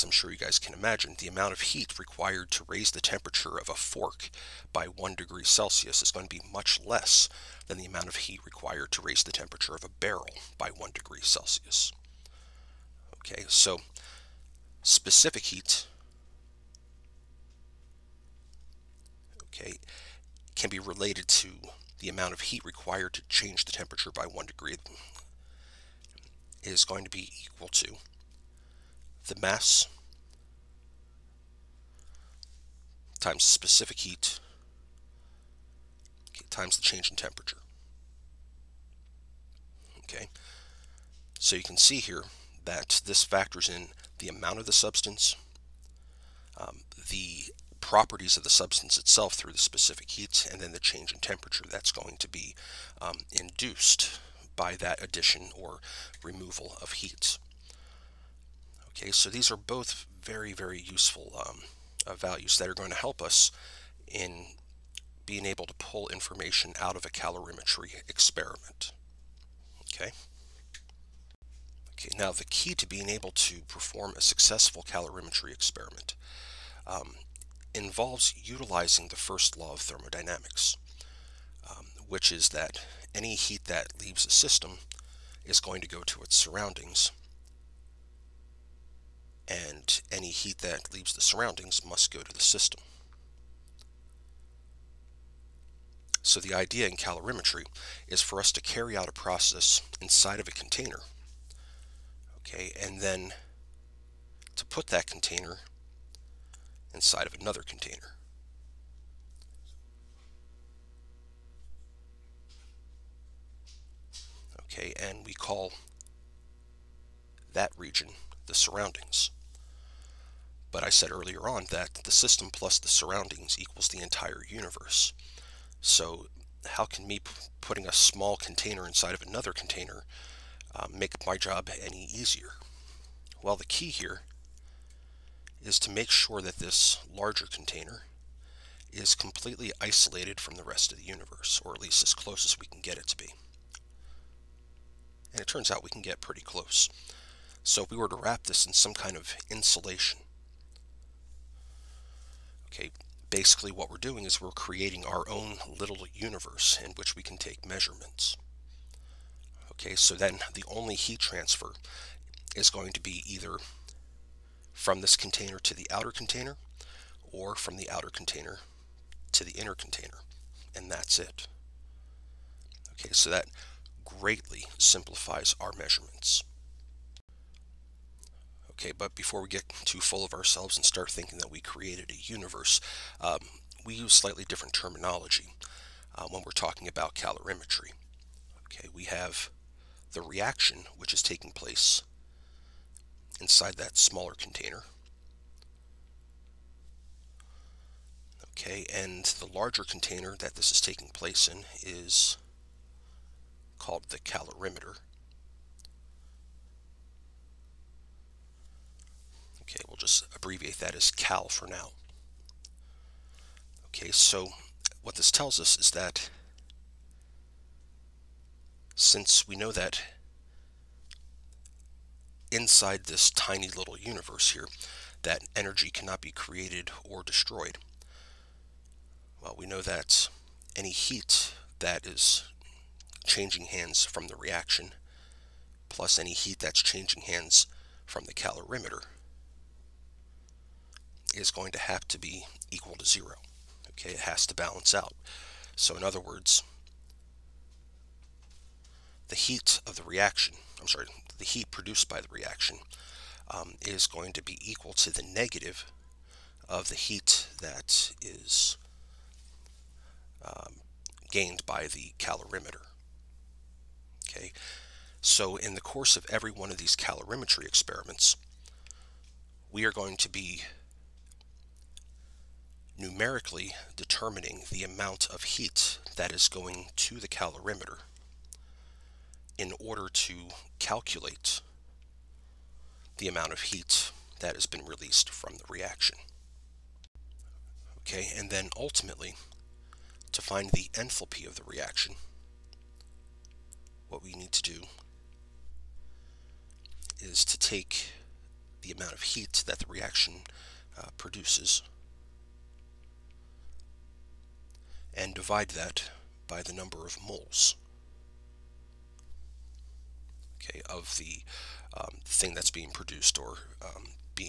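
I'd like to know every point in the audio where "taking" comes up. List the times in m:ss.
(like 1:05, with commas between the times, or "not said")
3:11, 3:20.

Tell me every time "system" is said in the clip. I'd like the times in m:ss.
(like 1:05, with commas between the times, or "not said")
1:24, 1:32, 2:02.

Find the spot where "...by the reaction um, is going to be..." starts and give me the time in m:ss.
4:12.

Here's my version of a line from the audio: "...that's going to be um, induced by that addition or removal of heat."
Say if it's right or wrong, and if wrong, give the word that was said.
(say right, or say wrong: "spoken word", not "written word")
right.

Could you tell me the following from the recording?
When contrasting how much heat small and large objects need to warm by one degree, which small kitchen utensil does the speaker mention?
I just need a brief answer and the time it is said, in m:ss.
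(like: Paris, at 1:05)
fork, at 0:03.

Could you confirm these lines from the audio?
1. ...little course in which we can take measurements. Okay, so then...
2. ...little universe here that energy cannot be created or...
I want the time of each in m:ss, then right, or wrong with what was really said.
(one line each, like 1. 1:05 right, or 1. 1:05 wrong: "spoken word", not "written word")
1. 2:35 wrong: "universe", not "course"
2. 3:43 right.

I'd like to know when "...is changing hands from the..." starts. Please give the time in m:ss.
3:52.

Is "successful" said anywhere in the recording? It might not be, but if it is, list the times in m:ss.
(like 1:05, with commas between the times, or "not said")
1:14.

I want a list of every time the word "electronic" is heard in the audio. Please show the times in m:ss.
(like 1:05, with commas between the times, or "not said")
not said.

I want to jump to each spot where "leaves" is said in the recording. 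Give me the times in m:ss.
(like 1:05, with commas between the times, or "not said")
1:24, 1:30.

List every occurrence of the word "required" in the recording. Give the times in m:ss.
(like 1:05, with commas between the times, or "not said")
0:01, 0:08, 0:22.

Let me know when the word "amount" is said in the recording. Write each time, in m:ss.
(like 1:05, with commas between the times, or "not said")
0:01, 0:07, 0:22, 0:44, 4:34, 4:43, 4:58.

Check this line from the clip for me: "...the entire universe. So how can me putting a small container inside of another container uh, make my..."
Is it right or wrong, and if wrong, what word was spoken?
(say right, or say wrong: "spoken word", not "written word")
right.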